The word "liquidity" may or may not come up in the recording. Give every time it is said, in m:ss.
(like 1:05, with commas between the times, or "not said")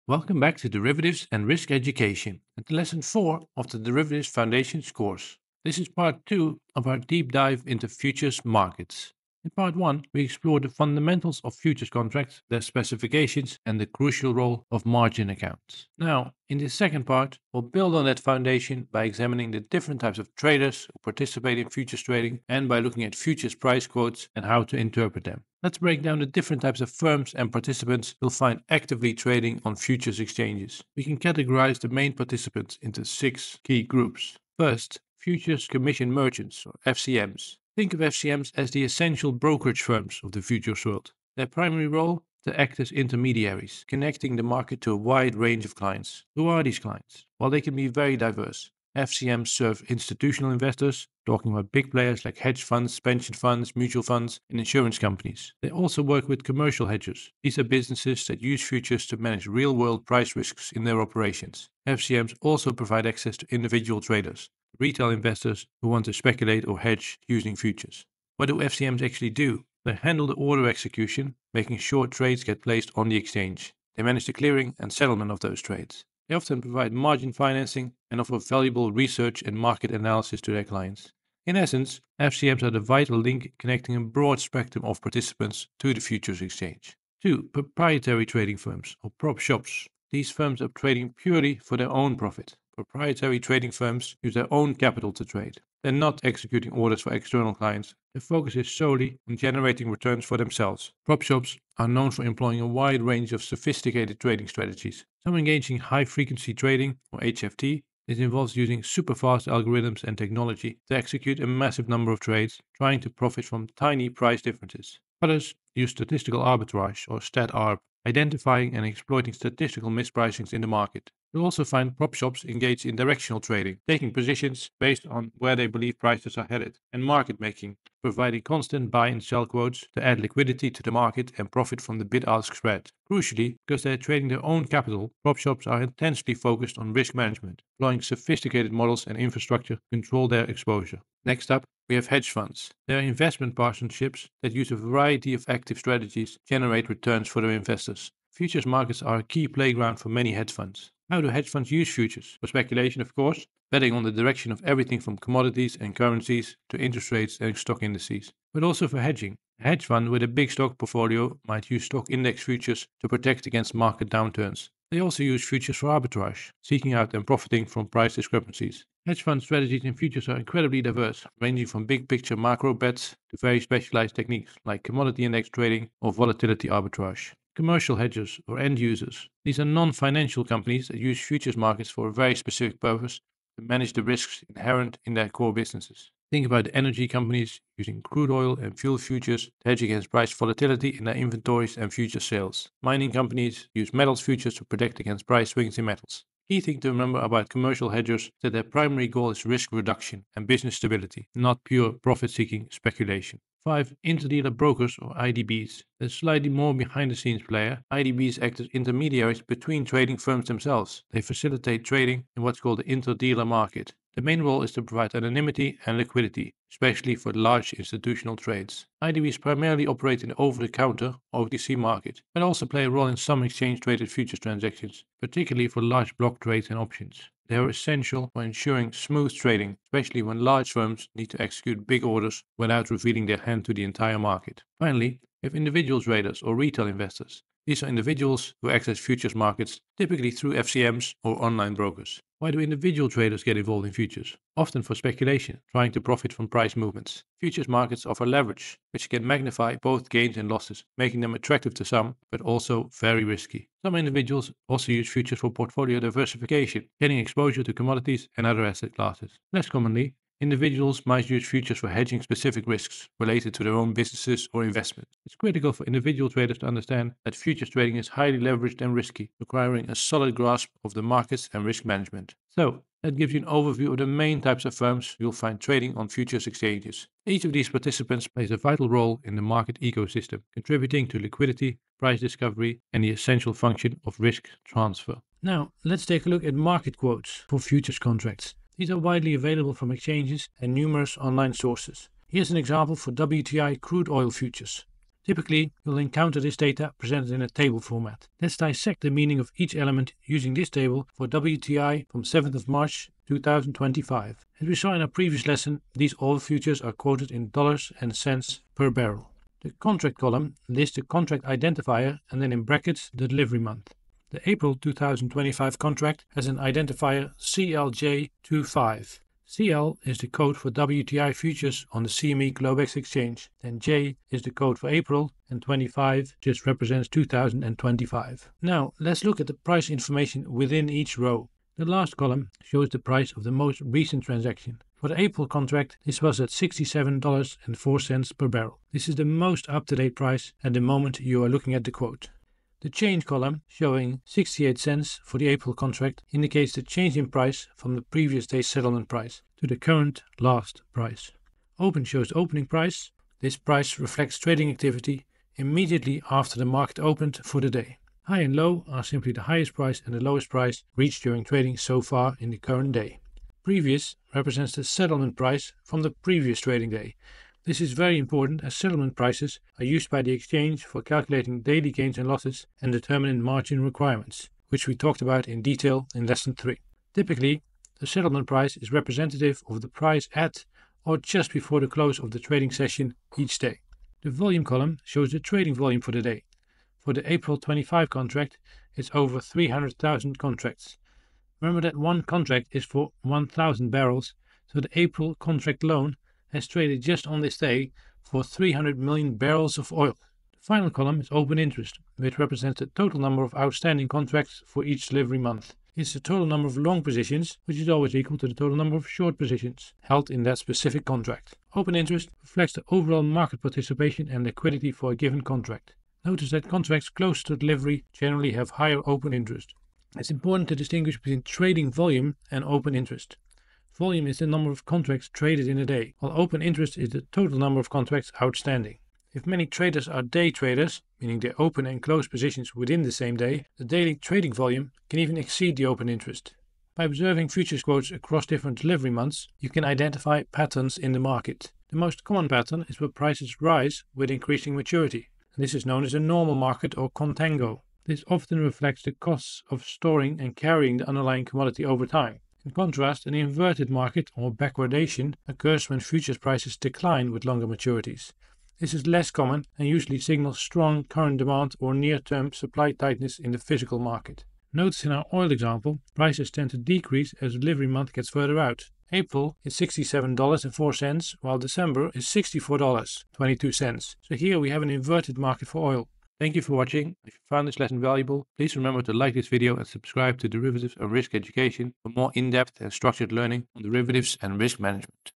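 2:10, 3:35, 4:41, 6:54.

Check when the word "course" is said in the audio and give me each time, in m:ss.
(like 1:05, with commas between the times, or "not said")
0:04, 2:33.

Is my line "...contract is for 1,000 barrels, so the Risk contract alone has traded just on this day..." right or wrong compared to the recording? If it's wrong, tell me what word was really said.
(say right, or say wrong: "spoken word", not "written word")
wrong: "April", not "Risk".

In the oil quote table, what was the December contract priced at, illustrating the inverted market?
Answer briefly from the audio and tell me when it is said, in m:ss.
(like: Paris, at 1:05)
$64.22, at 7:52.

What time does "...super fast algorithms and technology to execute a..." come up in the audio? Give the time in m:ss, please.
1:48.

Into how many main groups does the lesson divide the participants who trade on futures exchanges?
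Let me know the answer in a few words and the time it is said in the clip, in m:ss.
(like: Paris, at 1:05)
6, at 0:33.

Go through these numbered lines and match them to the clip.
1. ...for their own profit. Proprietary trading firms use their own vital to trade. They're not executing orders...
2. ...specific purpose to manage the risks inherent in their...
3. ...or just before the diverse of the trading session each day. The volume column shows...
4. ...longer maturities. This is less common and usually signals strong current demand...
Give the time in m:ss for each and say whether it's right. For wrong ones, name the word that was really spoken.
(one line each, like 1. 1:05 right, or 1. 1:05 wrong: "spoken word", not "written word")
1. 1:31 wrong: "capital", not "vital"
2. 3:02 right
3. 6:21 wrong: "close", not "diverse"
4. 7:37 right.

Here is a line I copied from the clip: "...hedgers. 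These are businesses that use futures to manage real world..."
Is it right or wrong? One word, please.
right.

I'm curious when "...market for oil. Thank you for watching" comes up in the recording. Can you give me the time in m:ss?
7:55.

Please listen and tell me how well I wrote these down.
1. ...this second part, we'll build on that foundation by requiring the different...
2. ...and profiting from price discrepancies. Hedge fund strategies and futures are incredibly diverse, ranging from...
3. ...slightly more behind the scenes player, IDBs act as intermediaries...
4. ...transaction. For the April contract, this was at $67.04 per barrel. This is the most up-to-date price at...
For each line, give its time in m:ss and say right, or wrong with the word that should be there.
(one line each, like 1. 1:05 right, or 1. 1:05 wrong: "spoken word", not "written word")
1. 0:16 wrong: "examining", not "requiring"
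2. 2:47 right
3. 3:26 right
4. 5:34 right.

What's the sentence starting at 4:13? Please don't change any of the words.
Some individuals also use futures for portfolio diversification, gaining exposure to commodities and other asset classes.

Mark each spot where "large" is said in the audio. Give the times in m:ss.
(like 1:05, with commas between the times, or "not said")
3:37, 3:45, 3:50.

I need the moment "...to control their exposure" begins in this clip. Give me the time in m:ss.
2:19.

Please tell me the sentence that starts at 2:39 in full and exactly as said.
A hedge fund with a big stock portfolio might use stock index futures to protect against market downturns.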